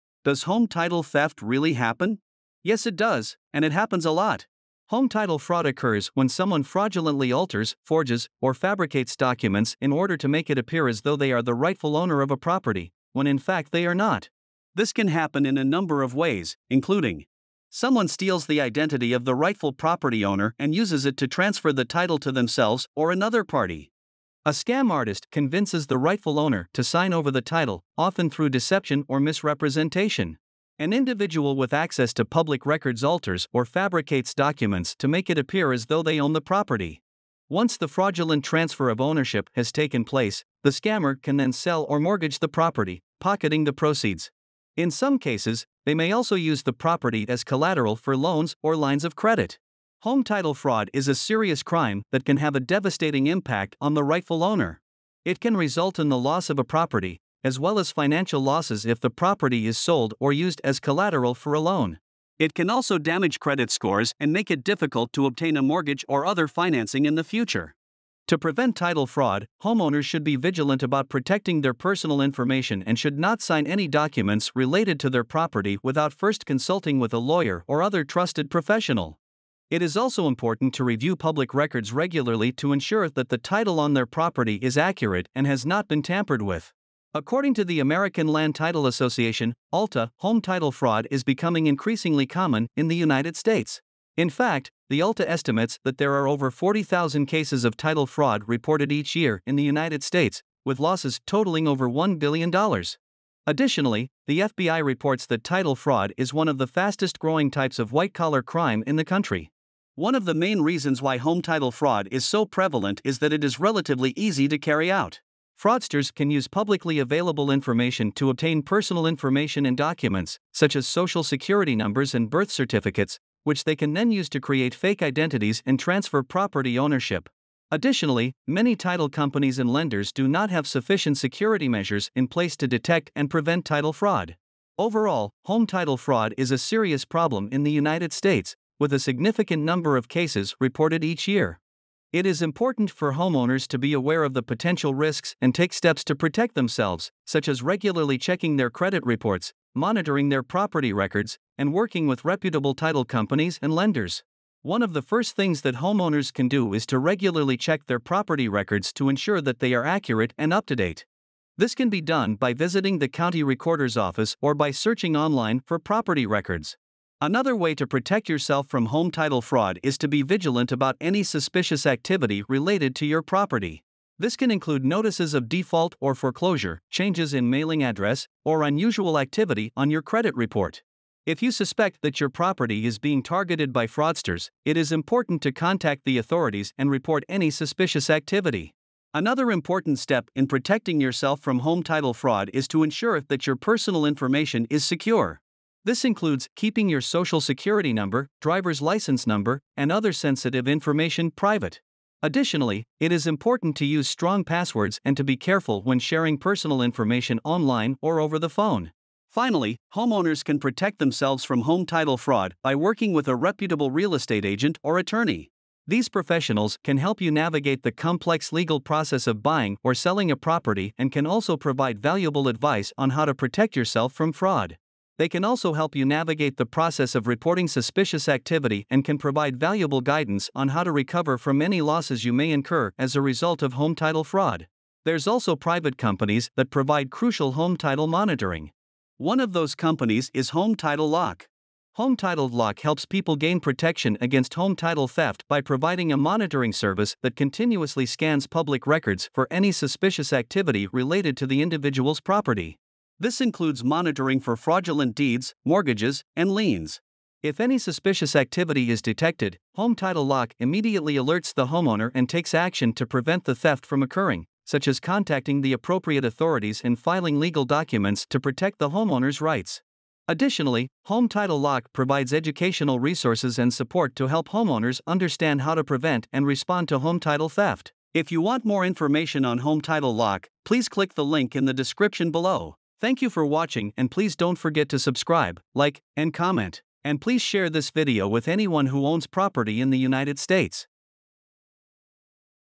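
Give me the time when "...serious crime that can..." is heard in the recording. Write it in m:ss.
0:51.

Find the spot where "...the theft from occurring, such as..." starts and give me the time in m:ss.
4:23.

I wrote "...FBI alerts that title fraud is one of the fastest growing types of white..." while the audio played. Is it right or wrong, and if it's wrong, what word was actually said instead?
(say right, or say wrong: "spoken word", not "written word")
wrong: "reports", not "alerts".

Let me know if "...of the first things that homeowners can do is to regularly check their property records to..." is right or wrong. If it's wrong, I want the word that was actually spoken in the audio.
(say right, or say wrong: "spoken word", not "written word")
right.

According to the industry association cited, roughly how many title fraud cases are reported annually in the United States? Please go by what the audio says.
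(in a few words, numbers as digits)
40,000.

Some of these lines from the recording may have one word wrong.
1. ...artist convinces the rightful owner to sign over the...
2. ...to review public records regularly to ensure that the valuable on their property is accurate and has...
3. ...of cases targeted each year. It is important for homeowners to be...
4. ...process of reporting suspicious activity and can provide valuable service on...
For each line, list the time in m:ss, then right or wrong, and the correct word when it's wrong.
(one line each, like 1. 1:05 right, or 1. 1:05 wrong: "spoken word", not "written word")
1. 0:24 right
2. 1:20 wrong: "title", not "valuable"
3. 2:19 wrong: "reported", not "targeted"
4. 3:46 wrong: "guidance", not "service".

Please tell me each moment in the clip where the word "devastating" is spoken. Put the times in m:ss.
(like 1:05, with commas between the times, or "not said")
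0:52.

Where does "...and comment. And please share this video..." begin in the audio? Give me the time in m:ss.
4:46.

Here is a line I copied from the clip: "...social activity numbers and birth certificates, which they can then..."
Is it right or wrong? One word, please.
wrong.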